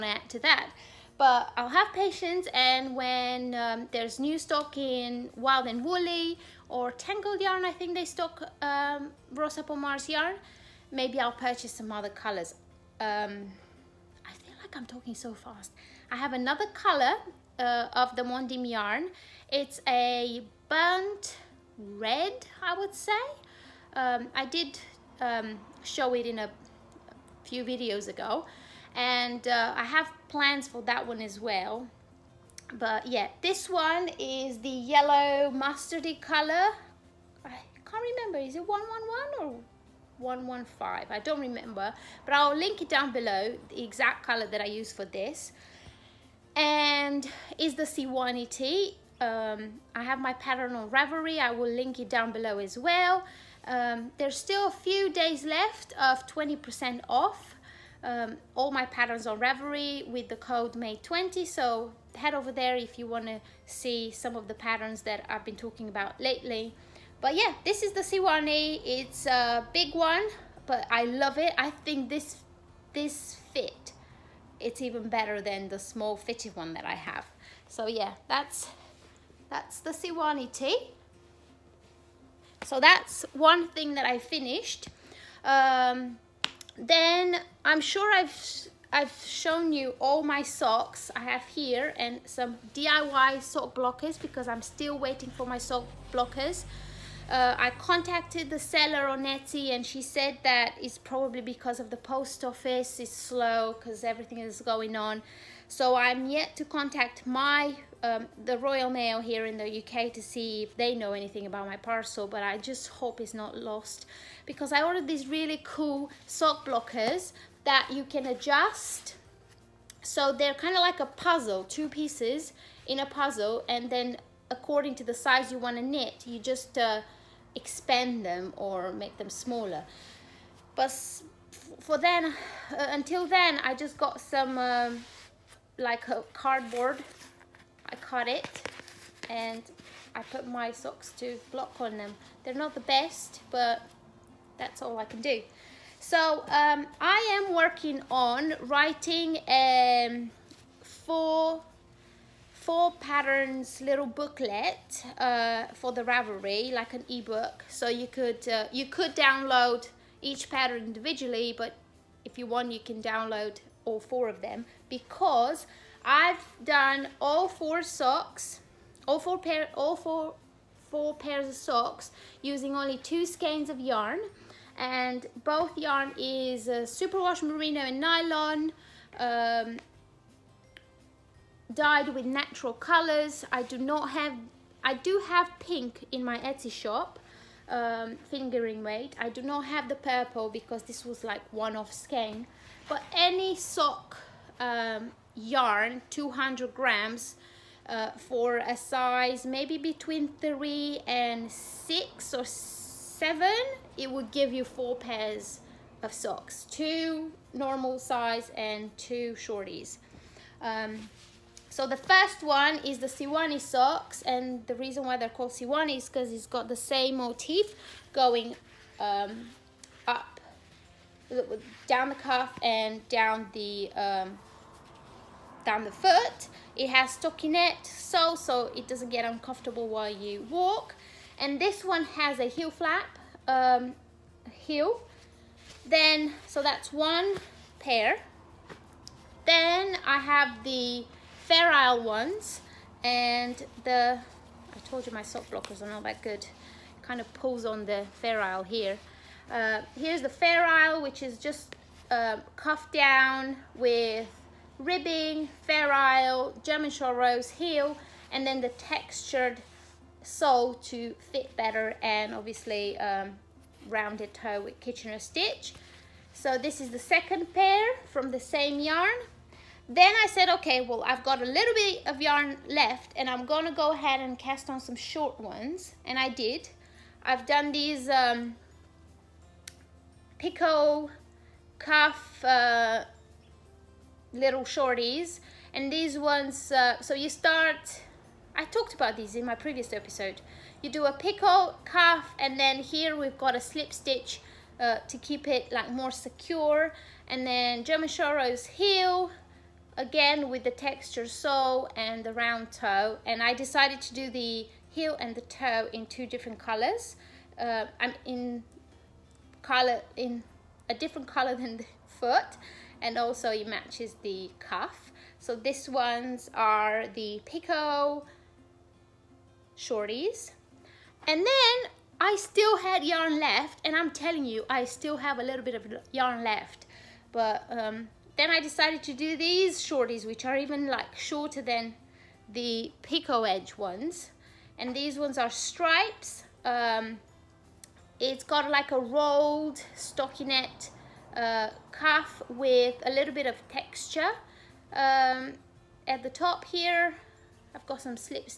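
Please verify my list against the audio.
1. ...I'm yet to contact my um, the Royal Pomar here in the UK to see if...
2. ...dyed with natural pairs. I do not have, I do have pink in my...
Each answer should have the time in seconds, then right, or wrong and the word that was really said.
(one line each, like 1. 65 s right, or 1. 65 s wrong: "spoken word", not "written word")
1. 105 s wrong: "Mail", not "Pomar"
2. 181 s wrong: "colors", not "pairs".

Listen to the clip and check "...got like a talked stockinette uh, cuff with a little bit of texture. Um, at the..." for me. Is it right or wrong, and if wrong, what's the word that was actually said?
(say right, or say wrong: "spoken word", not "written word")
wrong: "rolled", not "talked".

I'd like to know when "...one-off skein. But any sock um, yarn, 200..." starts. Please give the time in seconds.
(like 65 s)
191 s.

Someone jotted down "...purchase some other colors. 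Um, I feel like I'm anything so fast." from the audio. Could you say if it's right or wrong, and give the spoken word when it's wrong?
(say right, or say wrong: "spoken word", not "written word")
wrong: "talking", not "anything".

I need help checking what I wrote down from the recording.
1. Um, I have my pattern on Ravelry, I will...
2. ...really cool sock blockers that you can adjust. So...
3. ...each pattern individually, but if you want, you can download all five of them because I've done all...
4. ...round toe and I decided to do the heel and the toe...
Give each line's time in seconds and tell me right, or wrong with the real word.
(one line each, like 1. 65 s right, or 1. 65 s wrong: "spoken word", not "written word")
1. 49 s right
2. 115 s right
3. 160 s wrong: "four", not "five"
4. 302 s right.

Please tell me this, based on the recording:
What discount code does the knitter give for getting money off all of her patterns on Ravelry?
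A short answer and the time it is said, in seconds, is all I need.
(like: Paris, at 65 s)
MAY20, at 60 s.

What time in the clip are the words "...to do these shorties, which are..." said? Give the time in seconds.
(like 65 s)
329 s.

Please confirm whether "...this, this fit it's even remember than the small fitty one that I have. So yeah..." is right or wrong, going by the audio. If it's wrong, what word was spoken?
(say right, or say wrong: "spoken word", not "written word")
wrong: "better", not "remember".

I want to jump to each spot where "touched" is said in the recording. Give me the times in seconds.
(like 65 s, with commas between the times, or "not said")
not said.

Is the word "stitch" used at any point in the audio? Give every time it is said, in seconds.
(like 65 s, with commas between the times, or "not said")
265 s, 293 s.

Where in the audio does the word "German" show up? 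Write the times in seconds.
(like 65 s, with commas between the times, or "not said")
256 s, 297 s.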